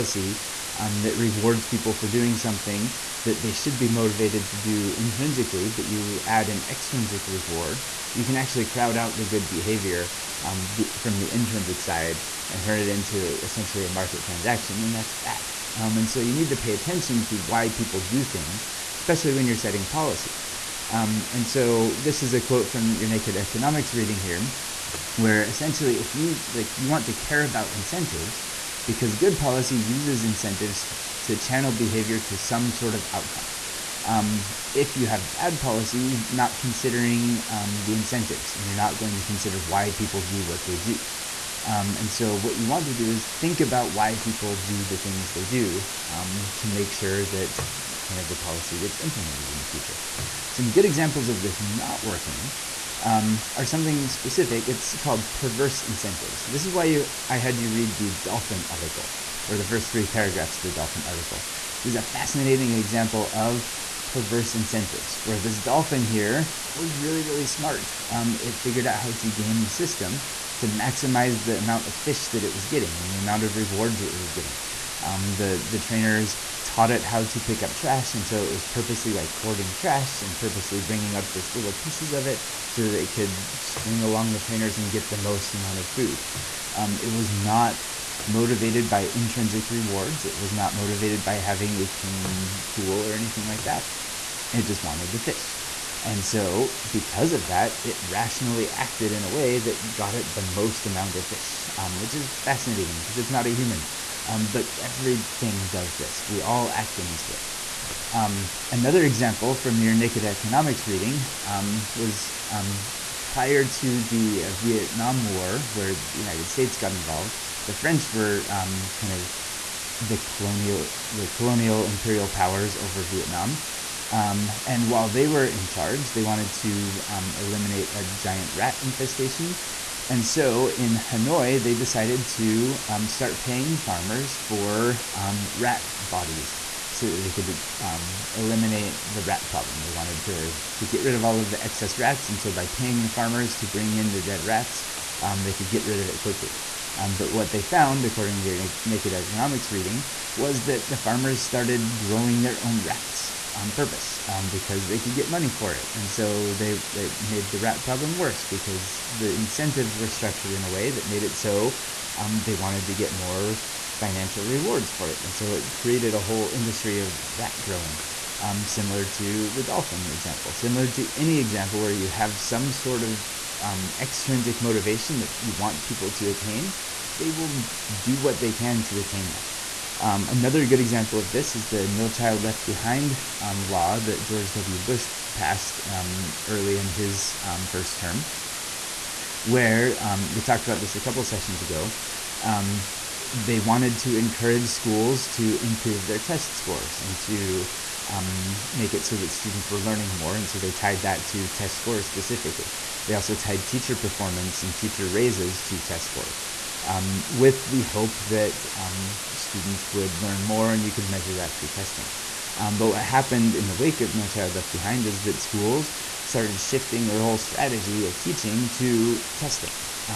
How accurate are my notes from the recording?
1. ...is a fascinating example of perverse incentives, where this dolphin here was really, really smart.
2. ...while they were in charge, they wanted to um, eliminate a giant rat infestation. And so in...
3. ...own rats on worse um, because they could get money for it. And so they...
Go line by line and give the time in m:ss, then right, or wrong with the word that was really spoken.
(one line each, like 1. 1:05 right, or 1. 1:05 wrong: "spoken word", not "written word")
1. 1:01 right
2. 2:04 right
3. 2:32 wrong: "purpose", not "worse".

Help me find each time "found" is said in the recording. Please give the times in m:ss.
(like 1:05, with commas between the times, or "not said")
2:27.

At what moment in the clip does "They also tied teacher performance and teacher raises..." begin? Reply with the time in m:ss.
3:23.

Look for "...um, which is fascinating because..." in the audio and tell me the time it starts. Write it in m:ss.
1:41.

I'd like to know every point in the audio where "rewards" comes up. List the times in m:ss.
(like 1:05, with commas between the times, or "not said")
0:01, 0:07, 1:13, 1:29, 2:44.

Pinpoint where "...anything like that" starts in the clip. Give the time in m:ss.
1:33.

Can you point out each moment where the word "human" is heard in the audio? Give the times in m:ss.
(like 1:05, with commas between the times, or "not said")
1:43.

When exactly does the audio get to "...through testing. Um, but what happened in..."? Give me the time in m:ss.
3:31.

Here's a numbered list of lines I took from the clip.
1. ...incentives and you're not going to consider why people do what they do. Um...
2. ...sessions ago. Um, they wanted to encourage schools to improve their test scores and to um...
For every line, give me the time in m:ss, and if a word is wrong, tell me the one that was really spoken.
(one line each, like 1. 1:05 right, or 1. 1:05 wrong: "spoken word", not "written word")
1. 0:37 right
2. 3:11 right.